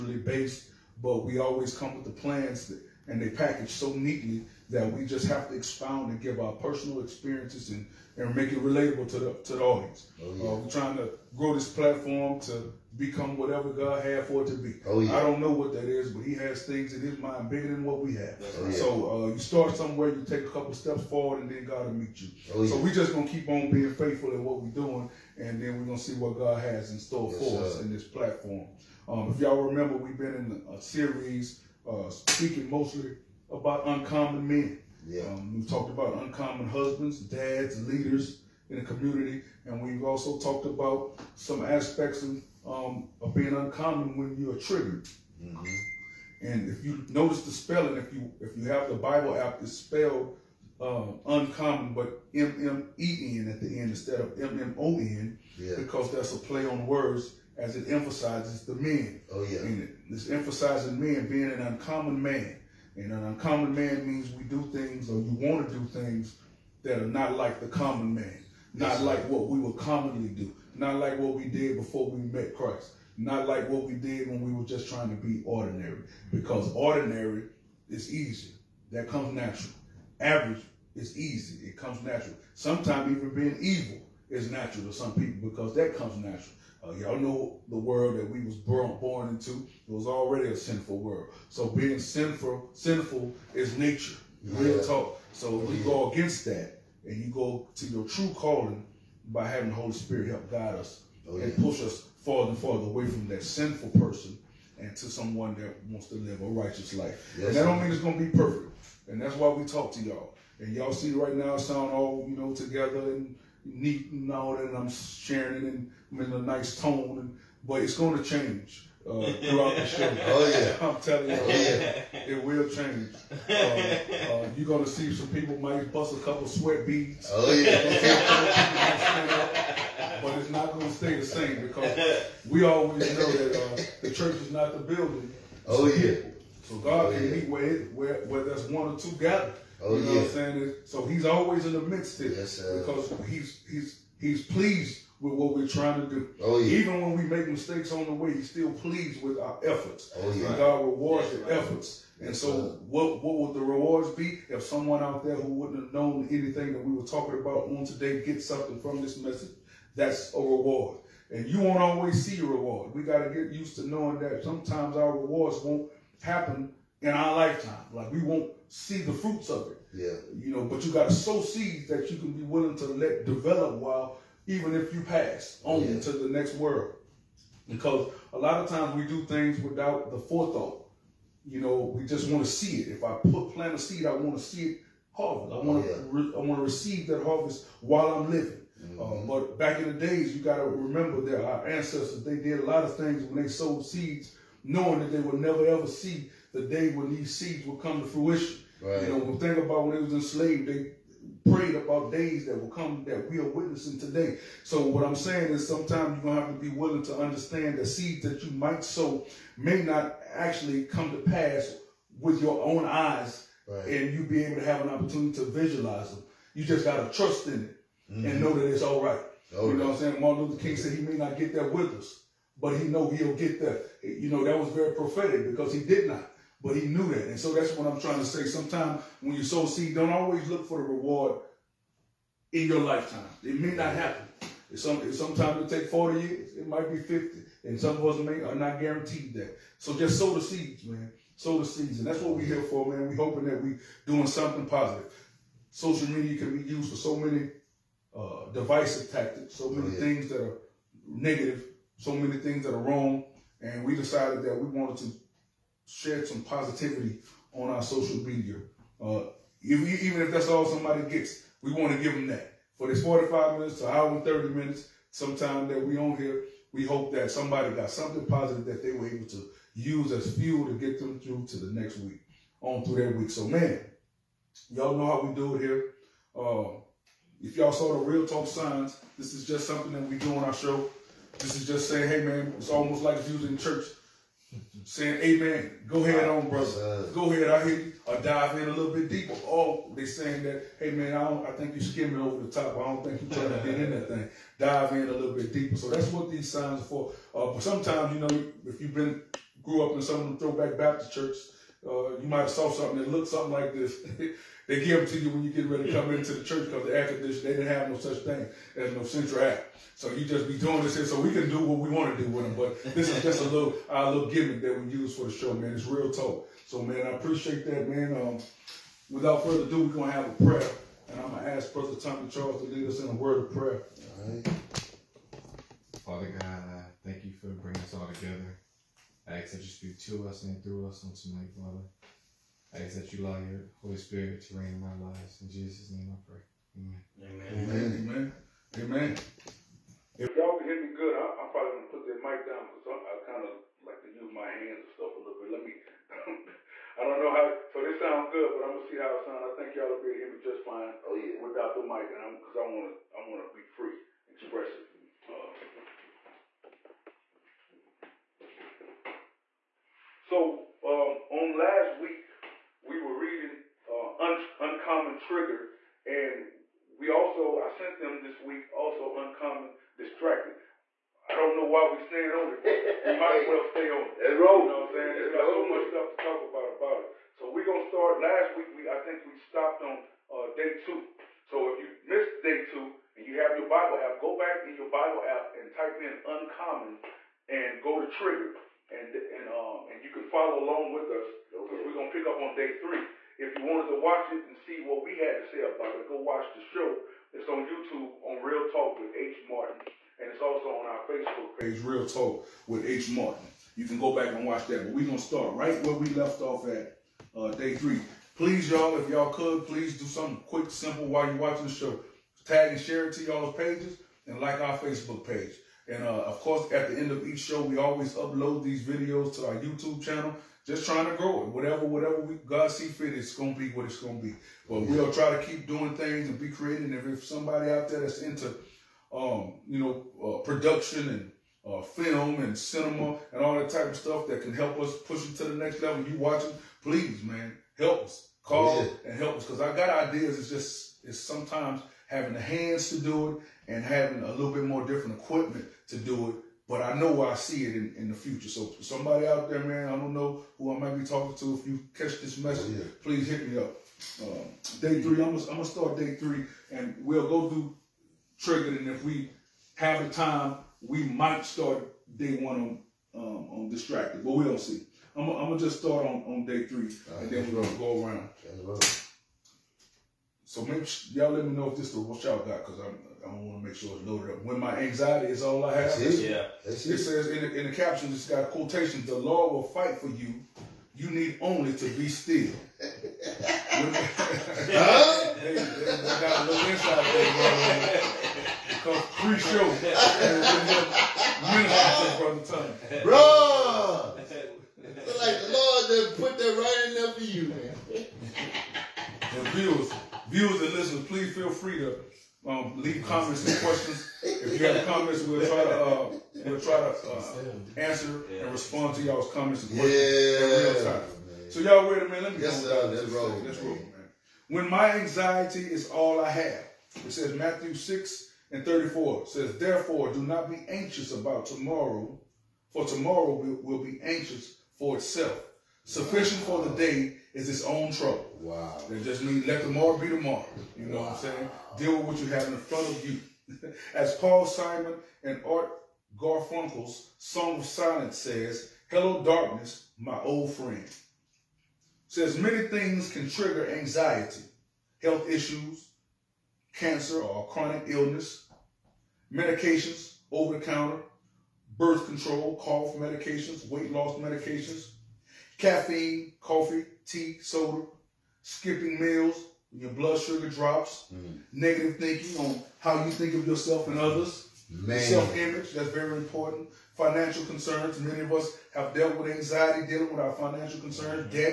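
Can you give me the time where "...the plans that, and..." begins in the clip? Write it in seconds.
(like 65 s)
2 s.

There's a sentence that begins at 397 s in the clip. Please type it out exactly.
It's on YouTube on Real Talk with H Martin, and it's also on our Facebook page, Real Talk with H Martin.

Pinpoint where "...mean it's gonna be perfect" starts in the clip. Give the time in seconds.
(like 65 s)
107 s.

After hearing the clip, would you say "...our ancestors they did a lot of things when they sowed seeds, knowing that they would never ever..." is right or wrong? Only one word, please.
right.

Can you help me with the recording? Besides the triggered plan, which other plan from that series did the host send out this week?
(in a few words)
Uncommon Distracted.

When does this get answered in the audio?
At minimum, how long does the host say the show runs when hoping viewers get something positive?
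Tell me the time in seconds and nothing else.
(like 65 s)
263 s.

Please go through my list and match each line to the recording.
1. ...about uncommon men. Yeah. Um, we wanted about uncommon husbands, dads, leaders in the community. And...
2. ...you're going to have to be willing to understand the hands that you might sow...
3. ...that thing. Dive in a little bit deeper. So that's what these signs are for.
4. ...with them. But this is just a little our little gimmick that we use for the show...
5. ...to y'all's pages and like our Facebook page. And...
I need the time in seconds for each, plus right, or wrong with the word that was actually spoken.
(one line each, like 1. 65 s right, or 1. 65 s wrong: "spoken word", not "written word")
1. 33 s wrong: "talked", not "wanted"
2. 206 s wrong: "seeds", not "hands"
3. 293 s right
4. 312 s right
5. 413 s right.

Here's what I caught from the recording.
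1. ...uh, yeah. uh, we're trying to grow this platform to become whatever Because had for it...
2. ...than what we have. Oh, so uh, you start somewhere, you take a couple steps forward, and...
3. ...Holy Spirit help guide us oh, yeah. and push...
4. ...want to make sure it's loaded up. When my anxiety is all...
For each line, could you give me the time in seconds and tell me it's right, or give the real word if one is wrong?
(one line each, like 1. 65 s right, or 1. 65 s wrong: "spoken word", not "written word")
1. 10 s wrong: "God", not "Because"
2. 17 s right
3. 99 s right
4. 473 s right.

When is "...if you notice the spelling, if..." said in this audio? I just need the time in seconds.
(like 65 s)
46 s.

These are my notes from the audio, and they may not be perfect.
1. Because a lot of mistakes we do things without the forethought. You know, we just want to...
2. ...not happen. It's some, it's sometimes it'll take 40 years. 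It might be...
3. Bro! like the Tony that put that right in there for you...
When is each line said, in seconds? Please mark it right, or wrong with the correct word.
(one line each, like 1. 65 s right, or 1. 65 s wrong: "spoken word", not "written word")
1. 177 s wrong: "times", not "mistakes"
2. 233 s right
3. 493 s wrong: "Lord", not "Tony".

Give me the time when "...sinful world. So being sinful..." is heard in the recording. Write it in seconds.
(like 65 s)
90 s.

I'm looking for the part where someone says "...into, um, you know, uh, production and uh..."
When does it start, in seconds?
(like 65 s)
428 s.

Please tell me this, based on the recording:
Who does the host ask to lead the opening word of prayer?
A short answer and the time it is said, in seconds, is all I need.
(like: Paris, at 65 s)
Tommy Charles, at 321 s.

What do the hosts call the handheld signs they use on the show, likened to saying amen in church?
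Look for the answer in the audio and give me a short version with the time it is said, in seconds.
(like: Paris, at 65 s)
Real Talk signs, at 278 s.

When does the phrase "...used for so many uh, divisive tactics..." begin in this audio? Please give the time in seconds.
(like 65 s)
246 s.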